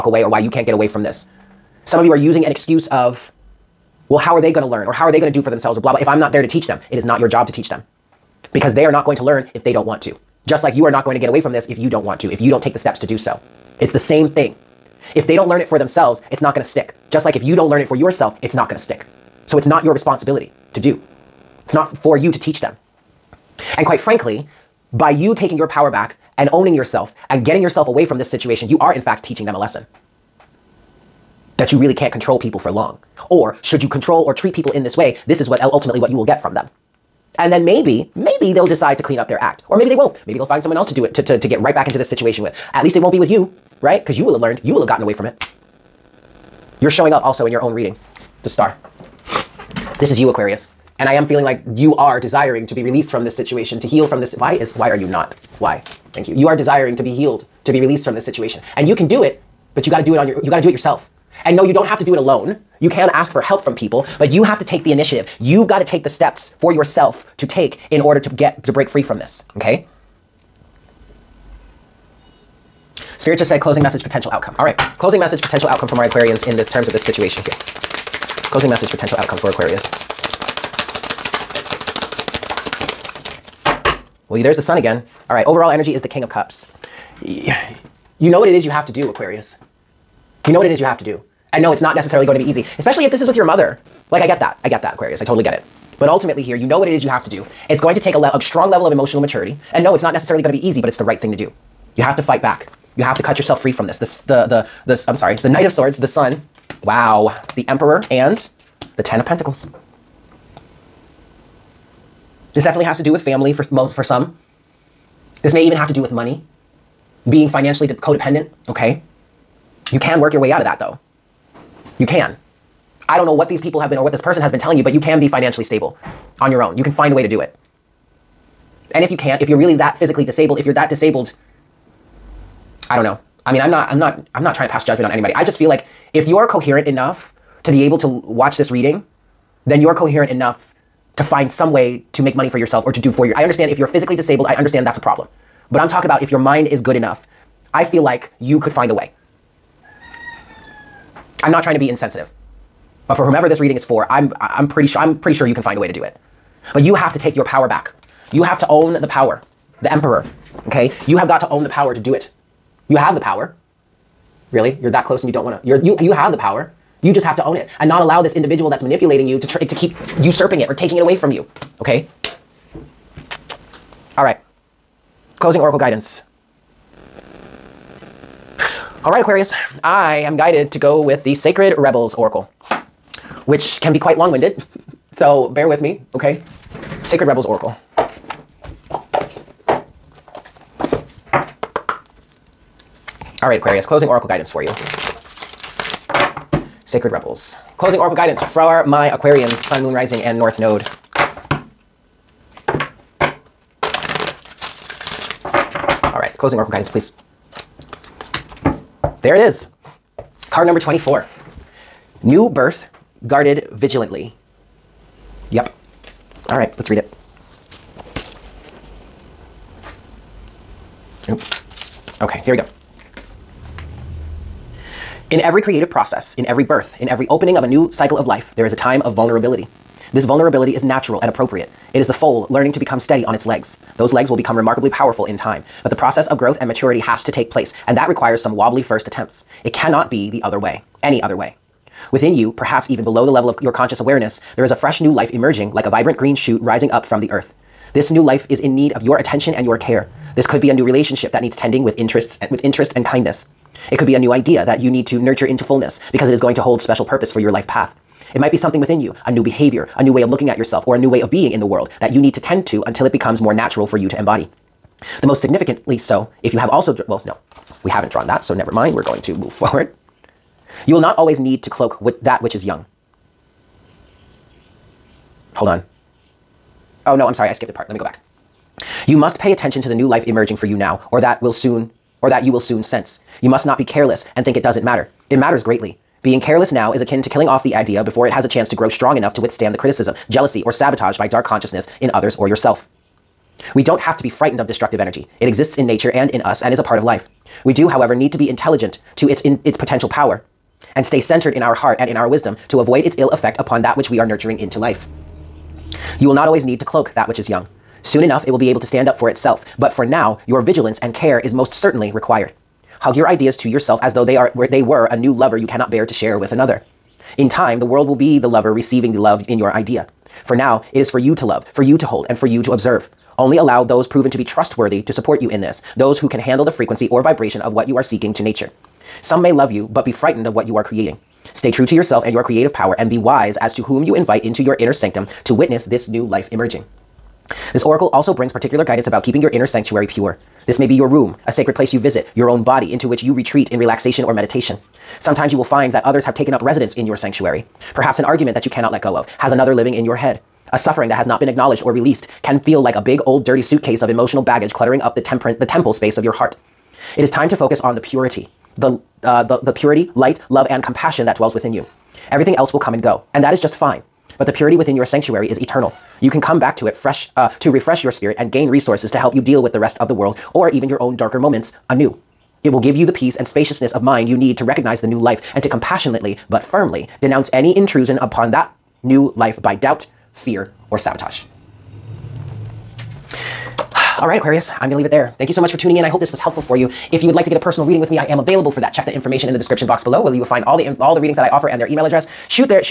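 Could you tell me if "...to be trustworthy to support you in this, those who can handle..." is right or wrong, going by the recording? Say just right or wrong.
right.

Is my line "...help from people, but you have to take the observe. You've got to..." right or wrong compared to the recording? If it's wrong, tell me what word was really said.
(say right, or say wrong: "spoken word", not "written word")
wrong: "initiative", not "observe".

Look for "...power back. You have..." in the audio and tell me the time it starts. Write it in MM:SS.
02:37.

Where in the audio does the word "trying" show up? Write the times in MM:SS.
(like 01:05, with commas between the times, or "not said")
02:14, 02:31.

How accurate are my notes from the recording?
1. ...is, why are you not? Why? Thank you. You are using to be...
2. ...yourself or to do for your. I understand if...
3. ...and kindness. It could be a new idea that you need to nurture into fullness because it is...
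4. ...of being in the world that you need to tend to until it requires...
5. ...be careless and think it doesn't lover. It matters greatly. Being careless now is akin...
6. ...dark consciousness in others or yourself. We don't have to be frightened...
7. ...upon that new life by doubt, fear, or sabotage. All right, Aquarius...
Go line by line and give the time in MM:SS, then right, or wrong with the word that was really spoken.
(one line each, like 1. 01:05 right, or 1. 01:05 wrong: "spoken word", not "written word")
1. 00:54 wrong: "desiring", not "using"
2. 02:22 right
3. 04:12 right
4. 04:21 wrong: "becomes", not "requires"
5. 04:43 wrong: "matter", not "lover"
6. 04:51 right
7. 06:18 right.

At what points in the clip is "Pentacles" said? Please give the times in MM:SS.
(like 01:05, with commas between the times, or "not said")
01:49.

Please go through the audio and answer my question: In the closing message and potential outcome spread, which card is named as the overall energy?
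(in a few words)
King of Cups.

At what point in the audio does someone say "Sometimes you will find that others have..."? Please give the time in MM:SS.
05:45.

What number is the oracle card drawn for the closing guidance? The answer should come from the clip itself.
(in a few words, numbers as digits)
24.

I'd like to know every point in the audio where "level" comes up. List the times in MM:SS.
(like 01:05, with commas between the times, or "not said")
01:38, 04:03.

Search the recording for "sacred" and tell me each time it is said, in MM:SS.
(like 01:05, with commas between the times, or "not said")
03:01, 03:07, 03:16, 05:41.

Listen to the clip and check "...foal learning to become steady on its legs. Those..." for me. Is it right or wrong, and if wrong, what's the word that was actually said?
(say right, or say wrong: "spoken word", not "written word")
right.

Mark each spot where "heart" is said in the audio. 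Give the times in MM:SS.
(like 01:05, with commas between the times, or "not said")
05:01, 05:56.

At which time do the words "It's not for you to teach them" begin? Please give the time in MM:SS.
00:21.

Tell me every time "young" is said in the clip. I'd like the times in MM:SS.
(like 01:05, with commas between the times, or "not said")
04:32, 05:07.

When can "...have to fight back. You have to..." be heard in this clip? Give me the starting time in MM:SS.
01:42.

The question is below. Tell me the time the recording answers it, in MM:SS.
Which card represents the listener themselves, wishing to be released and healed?
00:48.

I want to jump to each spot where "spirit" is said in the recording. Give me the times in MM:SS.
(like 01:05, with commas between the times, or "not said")
01:13, 06:08.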